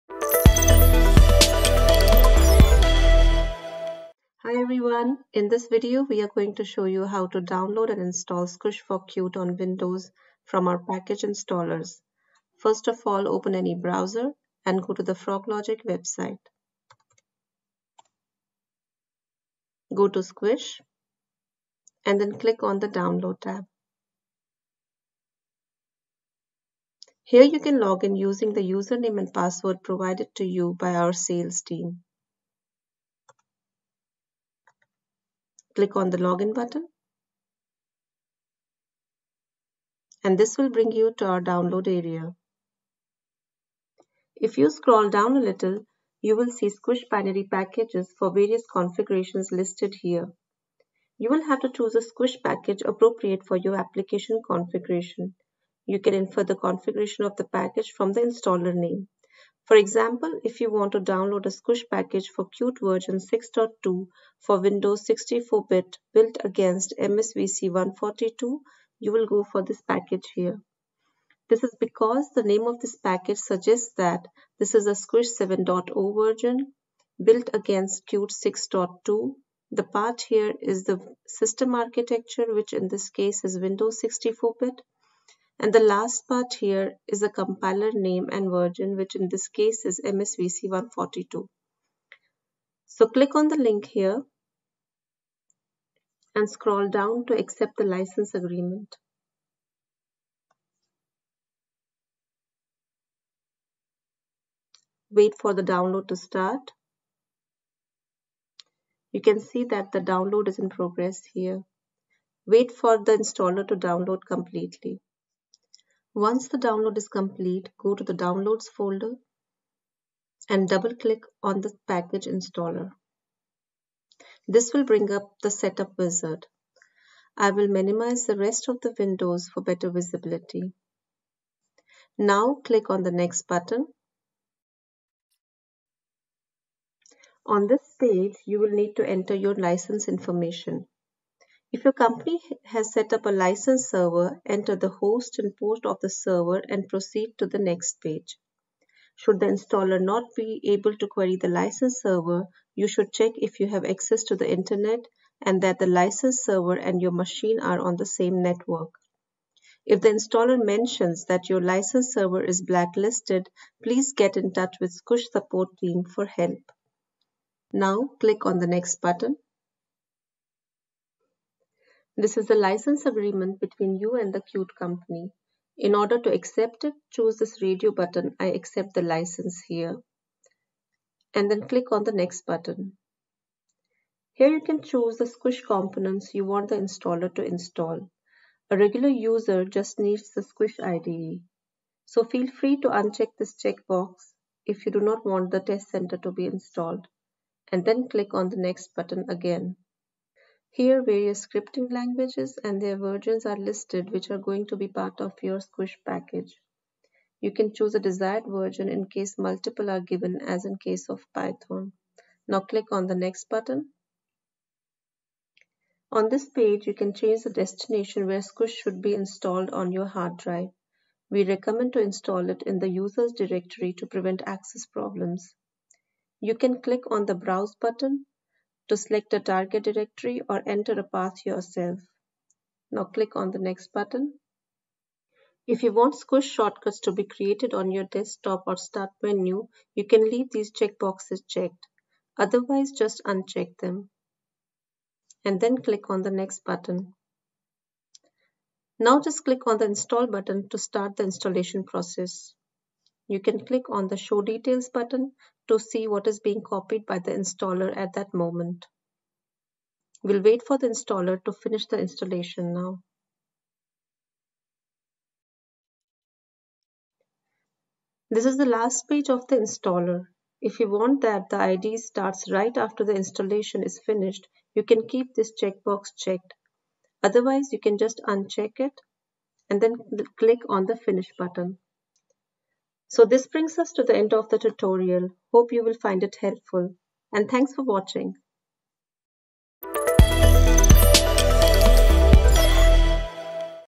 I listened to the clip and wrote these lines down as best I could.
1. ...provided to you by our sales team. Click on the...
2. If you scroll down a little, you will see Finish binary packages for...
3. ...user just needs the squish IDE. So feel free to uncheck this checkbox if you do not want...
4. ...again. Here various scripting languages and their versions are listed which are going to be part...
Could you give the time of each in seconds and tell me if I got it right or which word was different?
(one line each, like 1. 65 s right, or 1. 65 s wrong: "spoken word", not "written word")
1. 29 s right
2. 44 s wrong: "Squish", not "Finish"
3. 189 s right
4. 199 s right.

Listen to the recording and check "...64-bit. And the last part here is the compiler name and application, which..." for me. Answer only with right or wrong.
wrong.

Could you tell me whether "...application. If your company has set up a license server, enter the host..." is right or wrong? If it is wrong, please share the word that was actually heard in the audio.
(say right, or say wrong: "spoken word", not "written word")
wrong: "information", not "application".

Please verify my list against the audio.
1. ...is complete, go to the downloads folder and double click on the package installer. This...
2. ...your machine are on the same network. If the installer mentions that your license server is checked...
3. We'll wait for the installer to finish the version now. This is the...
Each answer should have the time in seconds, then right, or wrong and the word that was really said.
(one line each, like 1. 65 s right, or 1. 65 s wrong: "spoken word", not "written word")
1. 116 s right
2. 157 s wrong: "blacklisted", not "checked"
3. 260 s wrong: "installation", not "version".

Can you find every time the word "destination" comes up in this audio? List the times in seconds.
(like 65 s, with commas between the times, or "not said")
217 s.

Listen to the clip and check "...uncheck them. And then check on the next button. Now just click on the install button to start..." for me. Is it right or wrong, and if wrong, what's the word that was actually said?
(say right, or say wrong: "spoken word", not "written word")
wrong: "click", not "check".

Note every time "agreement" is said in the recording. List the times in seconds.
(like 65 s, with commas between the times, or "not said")
98 s, 173 s.